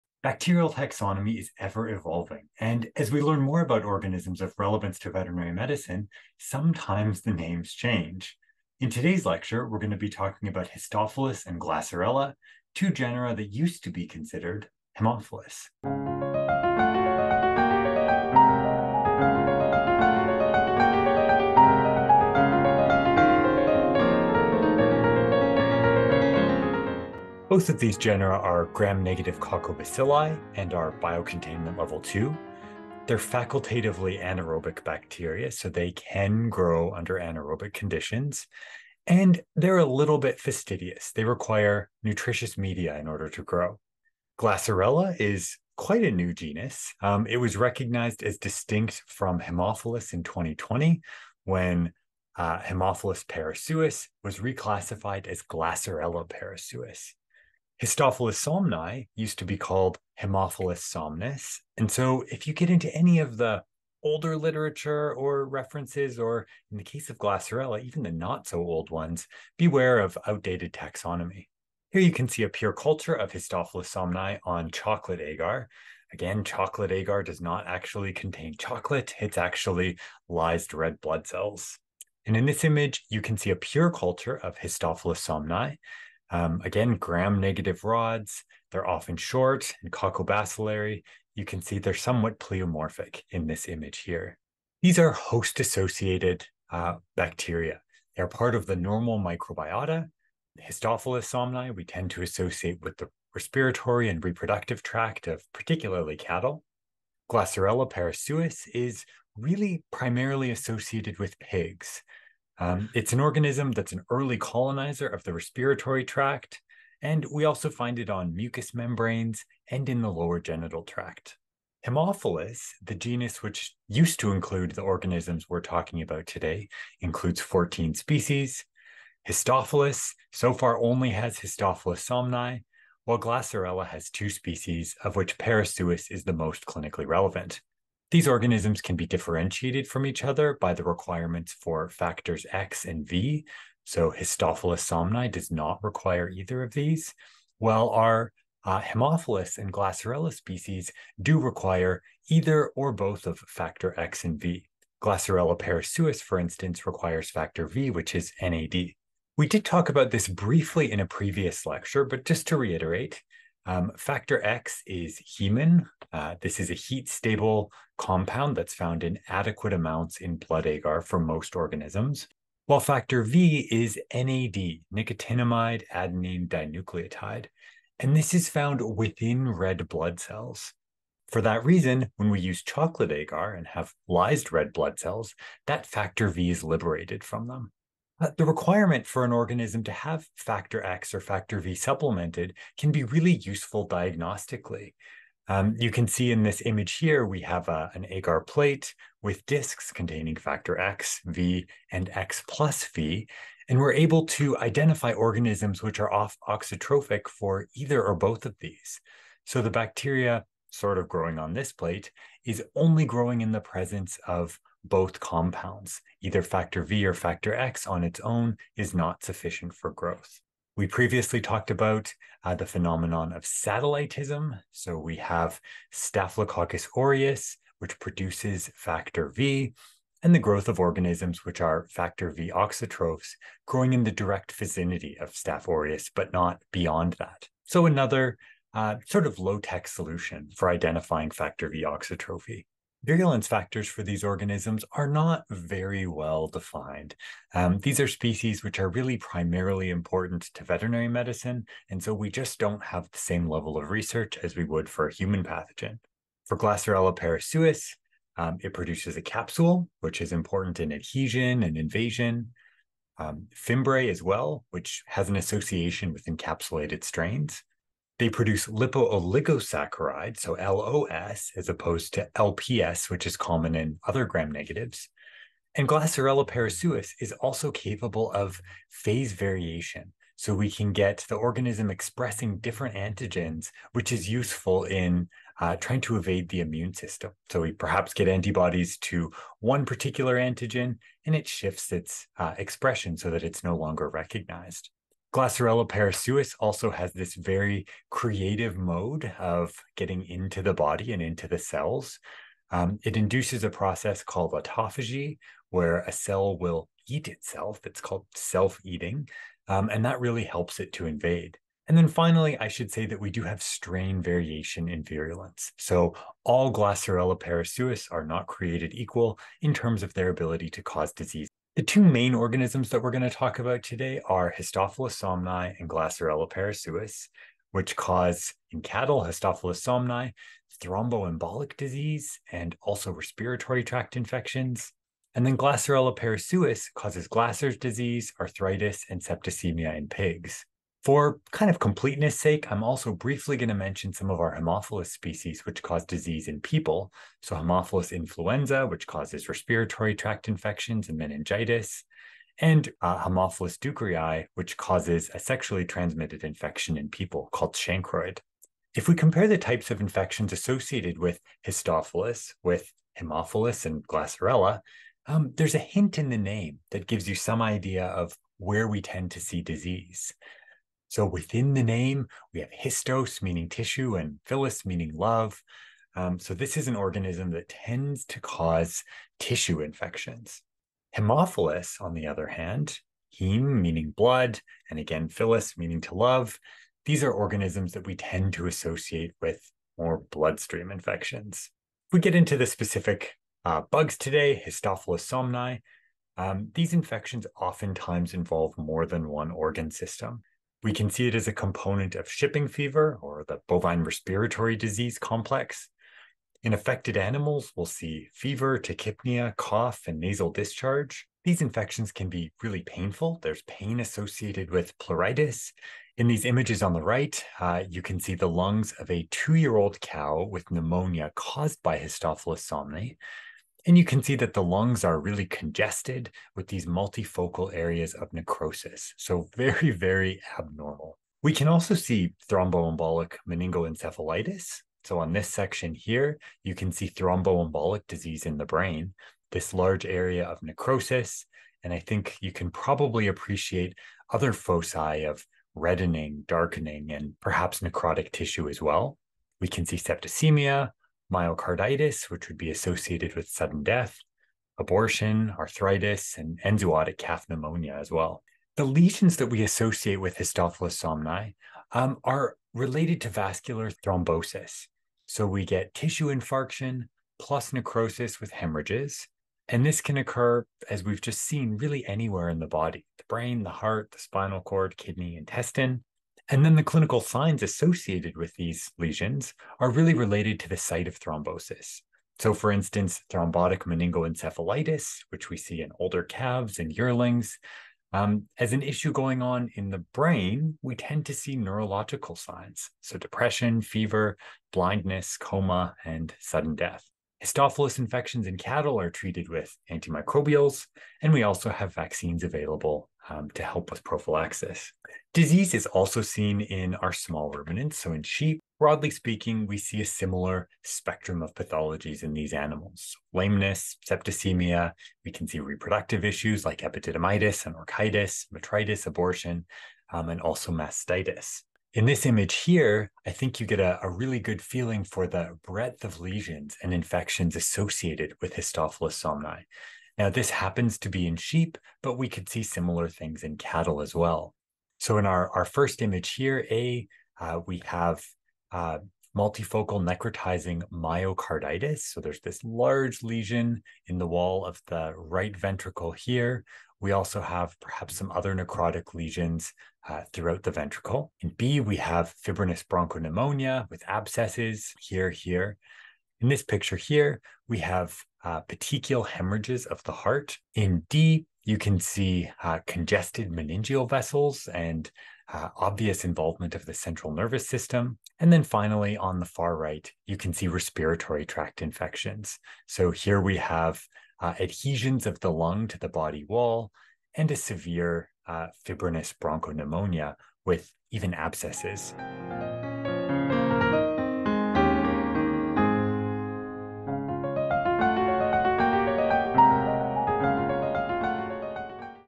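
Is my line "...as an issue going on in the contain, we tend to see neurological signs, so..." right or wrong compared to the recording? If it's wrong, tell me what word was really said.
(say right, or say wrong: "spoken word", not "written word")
wrong: "brain", not "contain".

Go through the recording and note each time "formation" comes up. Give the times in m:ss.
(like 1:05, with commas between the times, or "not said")
not said.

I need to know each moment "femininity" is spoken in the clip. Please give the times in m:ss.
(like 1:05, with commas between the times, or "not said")
not said.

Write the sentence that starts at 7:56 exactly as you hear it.
And then the clinical signs associated with these lesions are really related to the site of thrombosis.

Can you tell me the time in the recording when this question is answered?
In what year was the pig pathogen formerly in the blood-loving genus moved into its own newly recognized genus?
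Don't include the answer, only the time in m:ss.
0:50.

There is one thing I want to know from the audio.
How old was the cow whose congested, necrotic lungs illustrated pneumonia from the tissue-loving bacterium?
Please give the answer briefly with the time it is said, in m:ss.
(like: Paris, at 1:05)
2 years, at 6:59.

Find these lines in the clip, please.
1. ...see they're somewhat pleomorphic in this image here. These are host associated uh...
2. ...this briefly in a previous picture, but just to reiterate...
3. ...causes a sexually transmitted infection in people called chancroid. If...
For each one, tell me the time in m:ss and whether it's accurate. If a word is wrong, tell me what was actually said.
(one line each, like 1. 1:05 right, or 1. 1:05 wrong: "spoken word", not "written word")
1. 1:31 right
2. 2:40 wrong: "lecture", not "picture"
3. 5:54 right.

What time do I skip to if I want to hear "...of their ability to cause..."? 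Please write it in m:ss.
5:20.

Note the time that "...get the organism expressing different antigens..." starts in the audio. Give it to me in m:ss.
4:40.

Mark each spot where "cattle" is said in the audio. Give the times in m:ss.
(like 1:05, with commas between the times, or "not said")
1:46, 5:28, 8:18, 8:53.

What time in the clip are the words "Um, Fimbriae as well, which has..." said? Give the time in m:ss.
4:23.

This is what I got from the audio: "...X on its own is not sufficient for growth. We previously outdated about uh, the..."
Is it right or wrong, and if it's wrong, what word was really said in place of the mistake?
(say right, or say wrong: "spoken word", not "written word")
wrong: "talked", not "outdated".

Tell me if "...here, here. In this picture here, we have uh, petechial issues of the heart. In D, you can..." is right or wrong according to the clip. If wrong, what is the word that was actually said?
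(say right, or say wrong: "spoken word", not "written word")
wrong: "hemorrhages", not "issues".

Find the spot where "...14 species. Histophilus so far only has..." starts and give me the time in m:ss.
2:07.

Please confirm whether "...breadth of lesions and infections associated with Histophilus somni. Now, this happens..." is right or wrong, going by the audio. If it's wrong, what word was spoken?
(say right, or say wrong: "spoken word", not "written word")
right.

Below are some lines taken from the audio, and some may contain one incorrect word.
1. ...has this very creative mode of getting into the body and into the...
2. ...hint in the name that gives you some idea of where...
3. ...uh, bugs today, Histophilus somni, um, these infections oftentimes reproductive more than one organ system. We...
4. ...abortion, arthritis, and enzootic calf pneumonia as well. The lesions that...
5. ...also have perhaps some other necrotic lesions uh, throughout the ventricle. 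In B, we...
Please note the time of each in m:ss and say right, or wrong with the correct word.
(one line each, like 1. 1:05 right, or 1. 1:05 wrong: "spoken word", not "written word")
1. 4:56 right
2. 6:05 right
3. 6:33 wrong: "involve", not "reproductive"
4. 7:34 right
5. 9:07 right.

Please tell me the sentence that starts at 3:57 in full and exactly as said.
So another uh, sort of low-tech solution for identifying factor V auxotrophy.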